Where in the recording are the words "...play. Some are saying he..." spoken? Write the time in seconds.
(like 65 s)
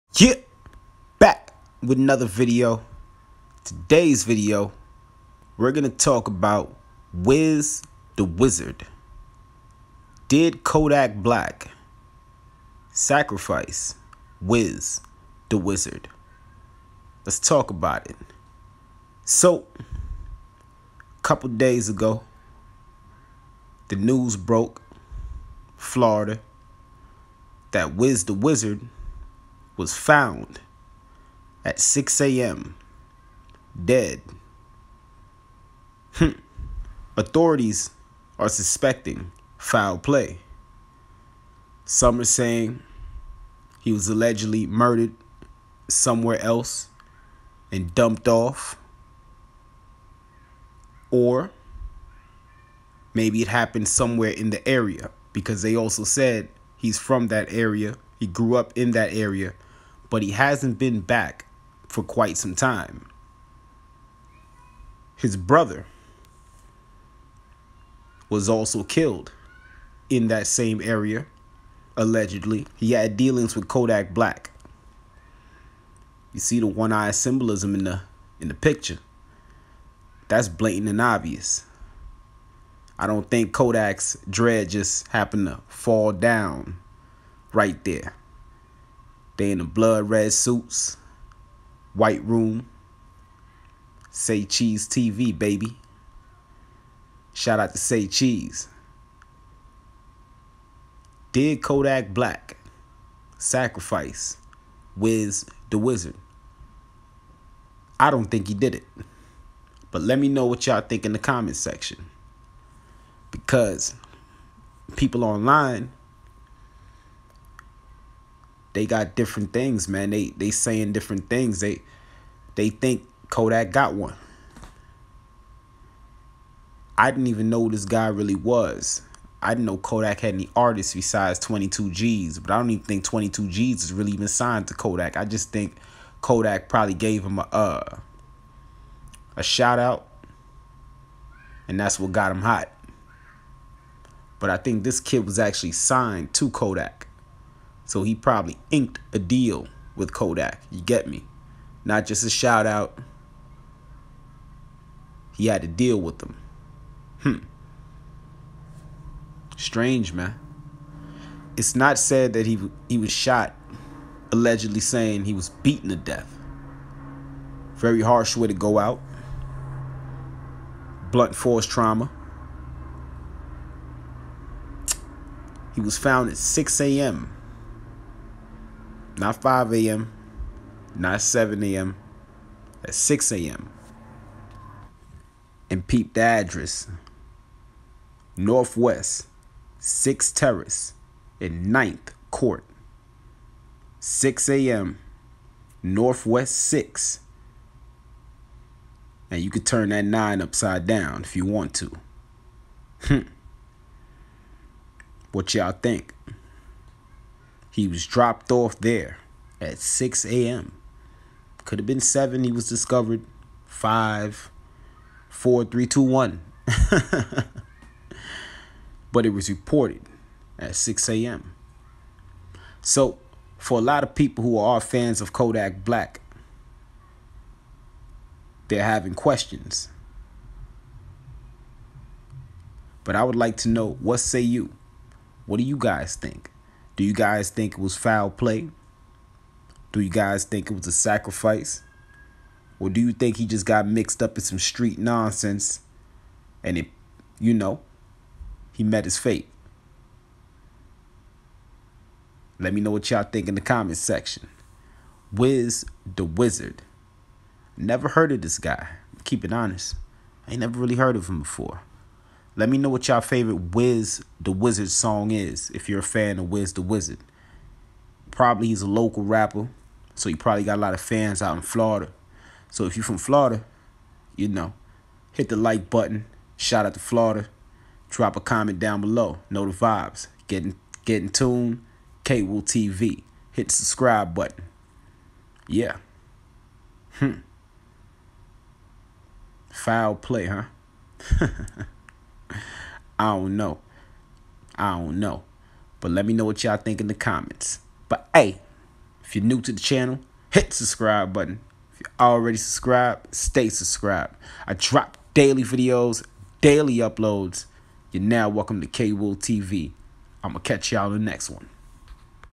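39 s.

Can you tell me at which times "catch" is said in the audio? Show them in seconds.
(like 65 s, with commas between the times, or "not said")
310 s.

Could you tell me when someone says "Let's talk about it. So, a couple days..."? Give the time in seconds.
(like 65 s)
17 s.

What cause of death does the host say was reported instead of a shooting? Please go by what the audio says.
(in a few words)
Blunt force trauma.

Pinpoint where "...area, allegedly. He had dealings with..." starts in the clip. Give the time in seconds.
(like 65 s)
70 s.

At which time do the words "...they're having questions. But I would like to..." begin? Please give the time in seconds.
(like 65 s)
228 s.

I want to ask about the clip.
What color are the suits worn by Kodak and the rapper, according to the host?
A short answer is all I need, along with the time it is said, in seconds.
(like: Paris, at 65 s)
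Blood red, at 89 s.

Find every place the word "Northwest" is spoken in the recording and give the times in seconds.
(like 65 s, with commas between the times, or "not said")
188 s, 195 s.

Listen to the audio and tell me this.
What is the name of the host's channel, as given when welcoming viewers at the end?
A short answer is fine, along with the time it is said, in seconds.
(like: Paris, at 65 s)
KwilTV, at 308 s.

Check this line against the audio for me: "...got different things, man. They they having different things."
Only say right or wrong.
wrong.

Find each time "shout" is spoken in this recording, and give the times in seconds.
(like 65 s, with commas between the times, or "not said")
97 s, 139 s, 152 s, 276 s.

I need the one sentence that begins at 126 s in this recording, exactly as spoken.
I didn't even know this guy really was.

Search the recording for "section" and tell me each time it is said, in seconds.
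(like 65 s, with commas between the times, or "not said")
111 s, 253 s.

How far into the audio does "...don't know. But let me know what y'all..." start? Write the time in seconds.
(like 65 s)
294 s.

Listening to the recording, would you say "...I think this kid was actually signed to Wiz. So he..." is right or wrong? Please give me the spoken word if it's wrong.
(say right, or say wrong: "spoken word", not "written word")
wrong: "Kodak", not "Wiz".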